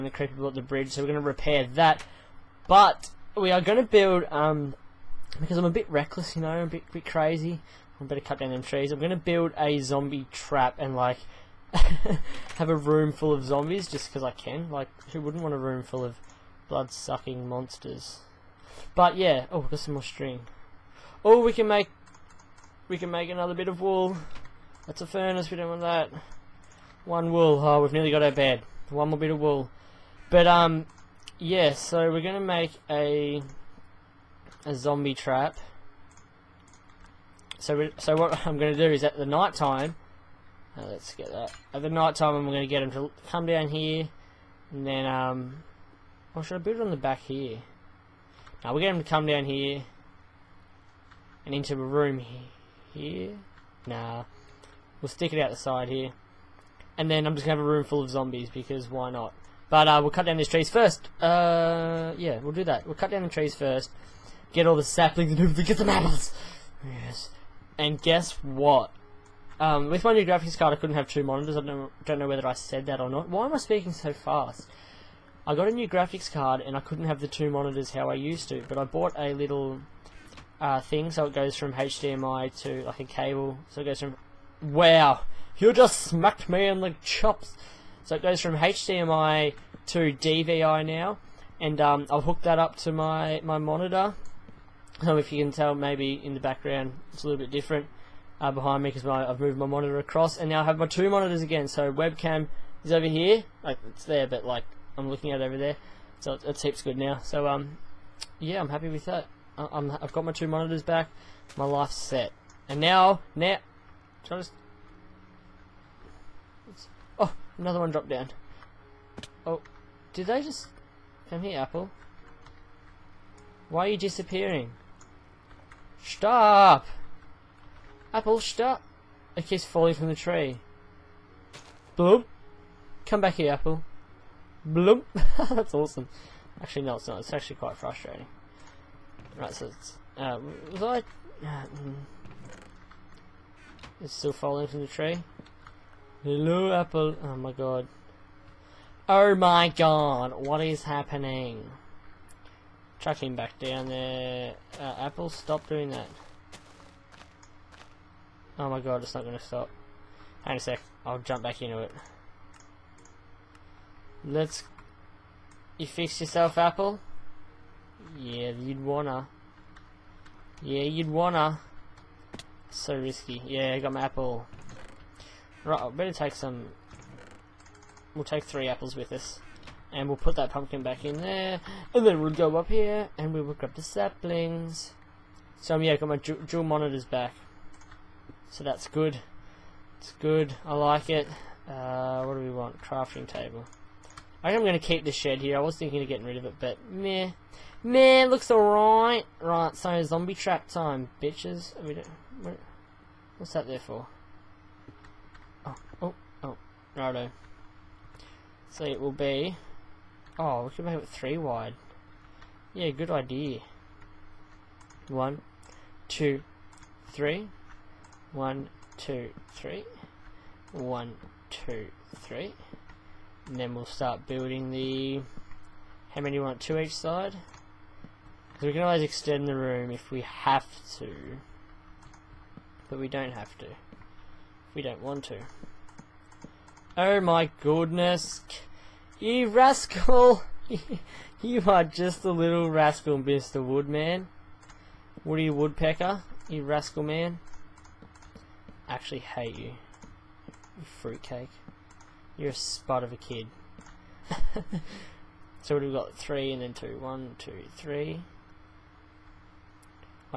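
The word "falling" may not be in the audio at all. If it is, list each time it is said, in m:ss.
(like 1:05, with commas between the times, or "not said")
2:09, 2:24.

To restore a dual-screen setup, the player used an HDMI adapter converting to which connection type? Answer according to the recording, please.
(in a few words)
DVI.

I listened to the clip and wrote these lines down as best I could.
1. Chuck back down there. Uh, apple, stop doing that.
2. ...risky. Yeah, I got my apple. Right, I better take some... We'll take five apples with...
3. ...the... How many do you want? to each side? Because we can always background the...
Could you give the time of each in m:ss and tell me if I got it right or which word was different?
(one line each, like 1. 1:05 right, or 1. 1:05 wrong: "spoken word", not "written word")
1. 2:32 right
2. 2:52 wrong: "three", not "five"
3. 3:44 wrong: "extend", not "background".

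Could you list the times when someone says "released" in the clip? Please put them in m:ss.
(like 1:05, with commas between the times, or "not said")
not said.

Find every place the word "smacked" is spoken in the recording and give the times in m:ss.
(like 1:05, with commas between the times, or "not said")
1:25.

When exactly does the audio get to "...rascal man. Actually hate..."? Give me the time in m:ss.
4:06.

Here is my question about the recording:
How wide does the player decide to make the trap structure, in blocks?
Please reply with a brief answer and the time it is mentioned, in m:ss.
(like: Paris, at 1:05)
3, at 3:31.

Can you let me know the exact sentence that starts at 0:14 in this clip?
Like, who wouldn't want a room full of blood-sucking monsters?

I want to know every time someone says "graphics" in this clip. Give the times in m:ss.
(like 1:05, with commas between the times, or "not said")
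1:10, 1:15.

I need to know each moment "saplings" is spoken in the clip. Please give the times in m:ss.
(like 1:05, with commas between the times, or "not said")
1:04, 3:03.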